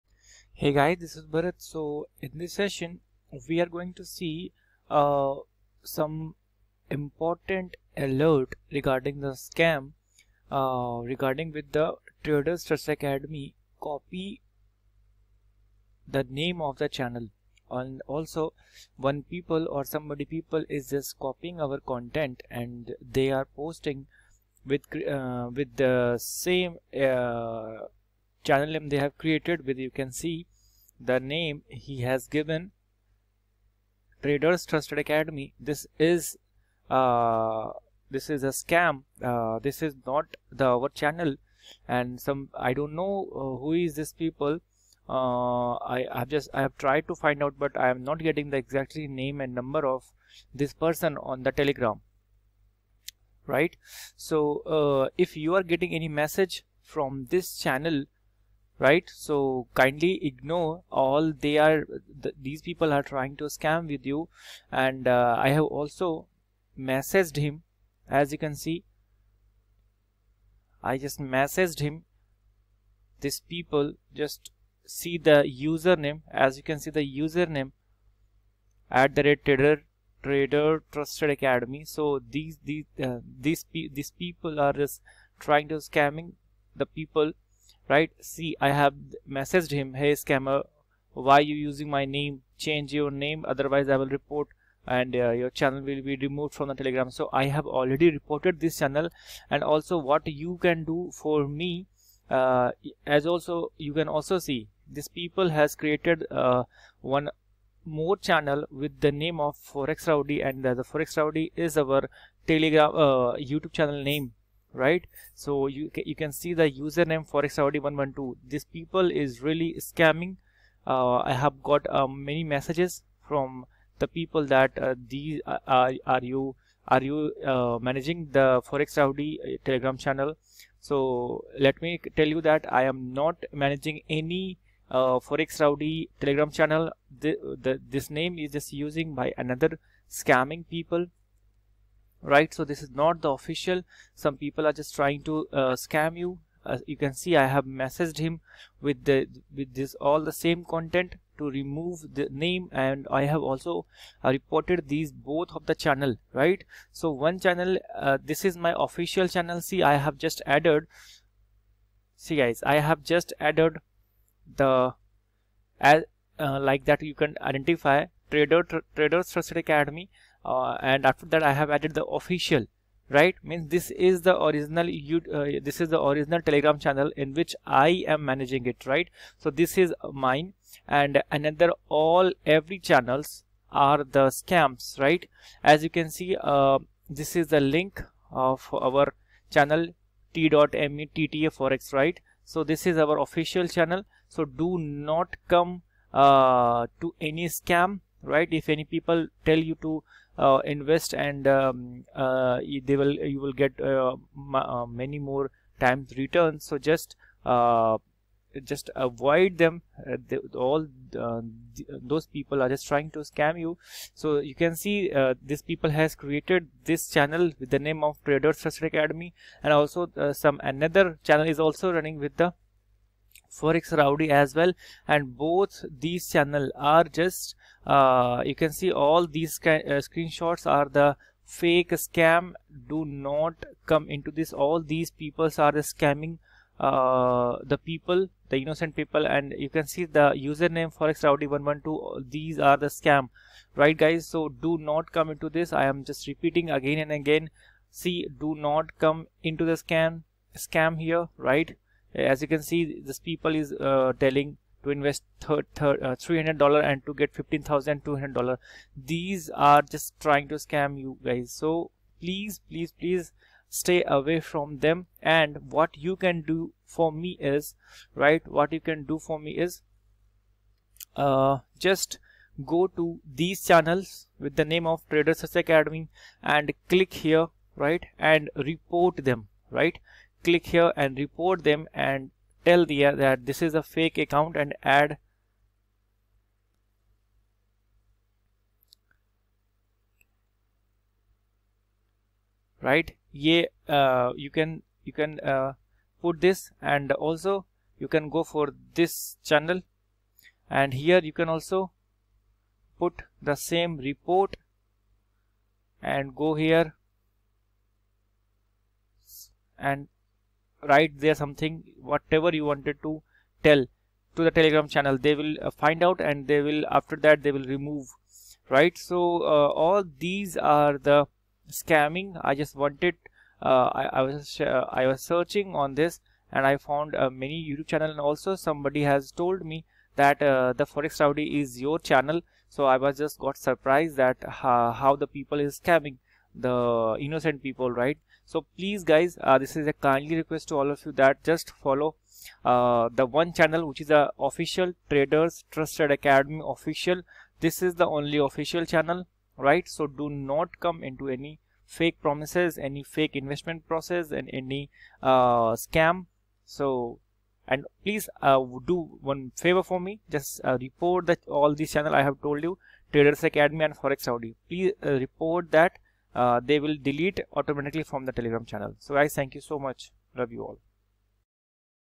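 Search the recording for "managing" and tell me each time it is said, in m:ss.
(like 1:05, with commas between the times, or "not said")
2:07, 2:13, 2:58.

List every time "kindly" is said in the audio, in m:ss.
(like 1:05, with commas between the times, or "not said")
0:59, 5:39.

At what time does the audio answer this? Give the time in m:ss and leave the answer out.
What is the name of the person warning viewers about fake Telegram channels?
0:01.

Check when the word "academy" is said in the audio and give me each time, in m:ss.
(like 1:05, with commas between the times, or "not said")
0:12, 0:35, 1:21, 2:49, 3:38, 4:35, 5:46, 6:03.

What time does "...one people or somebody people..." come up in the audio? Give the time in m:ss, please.
0:18.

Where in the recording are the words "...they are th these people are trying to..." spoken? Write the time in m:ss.
1:01.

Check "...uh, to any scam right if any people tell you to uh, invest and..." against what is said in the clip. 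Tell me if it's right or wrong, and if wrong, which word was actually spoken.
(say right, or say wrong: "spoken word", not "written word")
right.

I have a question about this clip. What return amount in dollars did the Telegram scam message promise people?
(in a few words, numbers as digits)
$15,200.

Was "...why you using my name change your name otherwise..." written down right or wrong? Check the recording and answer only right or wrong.
right.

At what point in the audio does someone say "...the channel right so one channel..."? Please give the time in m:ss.
2:35.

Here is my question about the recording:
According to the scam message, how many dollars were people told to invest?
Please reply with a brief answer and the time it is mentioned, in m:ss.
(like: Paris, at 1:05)
$300, at 4:16.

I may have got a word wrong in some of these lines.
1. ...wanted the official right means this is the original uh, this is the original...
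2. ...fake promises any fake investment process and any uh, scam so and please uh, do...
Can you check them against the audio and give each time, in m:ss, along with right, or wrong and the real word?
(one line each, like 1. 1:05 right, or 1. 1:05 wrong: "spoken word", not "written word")
1. 2:51 wrong: "added", not "wanted"
2. 5:51 right.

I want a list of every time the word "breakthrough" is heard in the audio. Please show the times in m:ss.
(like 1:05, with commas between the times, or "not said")
not said.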